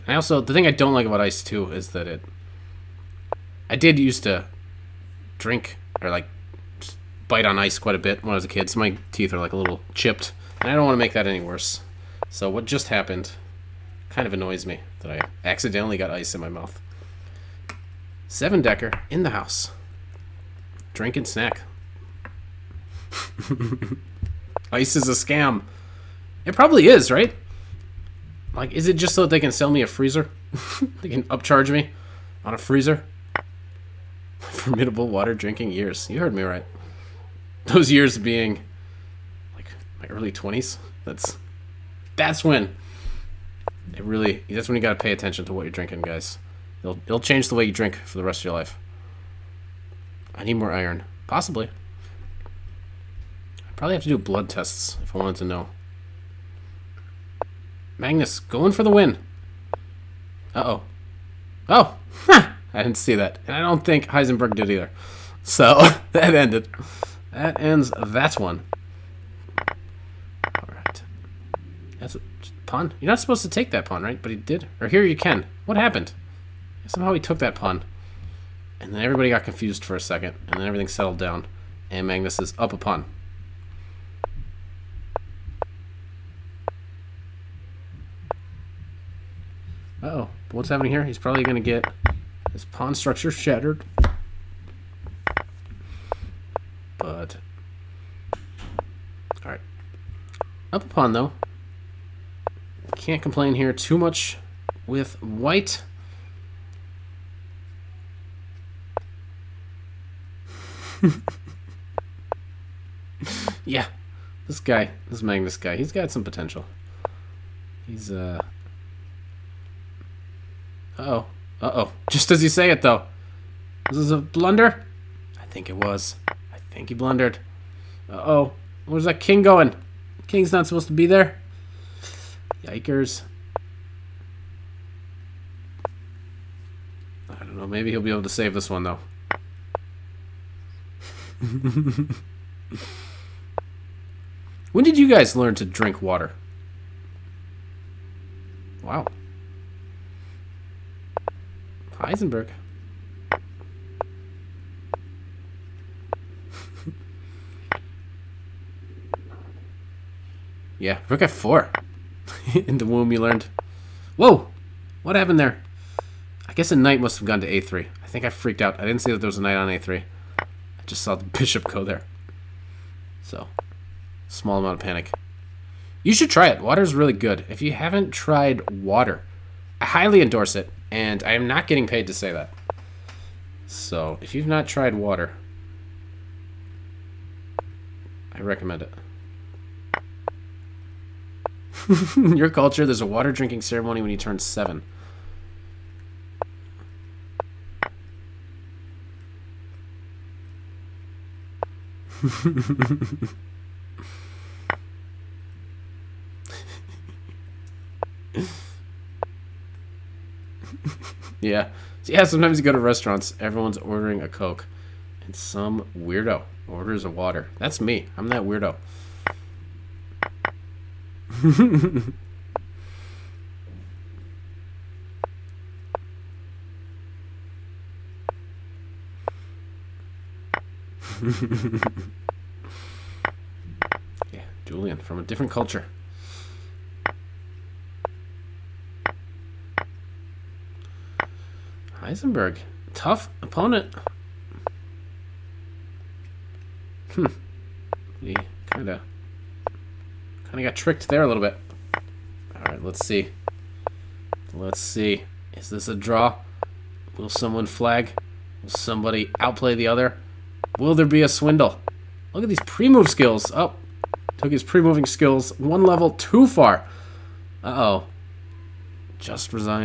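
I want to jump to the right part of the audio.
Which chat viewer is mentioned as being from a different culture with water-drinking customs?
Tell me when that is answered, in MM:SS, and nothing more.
03:54.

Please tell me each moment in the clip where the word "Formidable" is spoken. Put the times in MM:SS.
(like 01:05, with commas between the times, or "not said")
00:34.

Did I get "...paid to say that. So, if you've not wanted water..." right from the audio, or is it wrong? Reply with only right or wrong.
wrong.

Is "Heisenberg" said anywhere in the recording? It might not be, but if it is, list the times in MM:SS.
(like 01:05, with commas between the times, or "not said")
01:04, 02:31, 04:02.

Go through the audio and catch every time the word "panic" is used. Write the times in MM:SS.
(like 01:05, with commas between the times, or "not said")
02:54.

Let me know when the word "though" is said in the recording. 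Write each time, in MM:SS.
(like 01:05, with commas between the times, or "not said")
01:41, 02:02, 02:18.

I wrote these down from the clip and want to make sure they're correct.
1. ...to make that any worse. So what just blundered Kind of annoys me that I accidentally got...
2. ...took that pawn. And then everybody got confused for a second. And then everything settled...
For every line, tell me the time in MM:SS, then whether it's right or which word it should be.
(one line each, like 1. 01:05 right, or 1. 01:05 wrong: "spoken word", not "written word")
1. 00:10 wrong: "happened", not "blundered"
2. 01:17 right.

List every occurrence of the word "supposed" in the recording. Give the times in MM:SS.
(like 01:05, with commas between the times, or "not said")
01:13, 02:10.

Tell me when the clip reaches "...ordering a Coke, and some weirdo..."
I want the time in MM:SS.
03:33.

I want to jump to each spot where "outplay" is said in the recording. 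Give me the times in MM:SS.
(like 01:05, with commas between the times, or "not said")
04:19.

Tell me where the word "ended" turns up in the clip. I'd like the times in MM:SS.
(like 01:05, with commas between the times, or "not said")
01:06.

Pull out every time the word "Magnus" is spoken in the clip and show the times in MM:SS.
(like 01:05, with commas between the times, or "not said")
00:57, 01:22, 01:55.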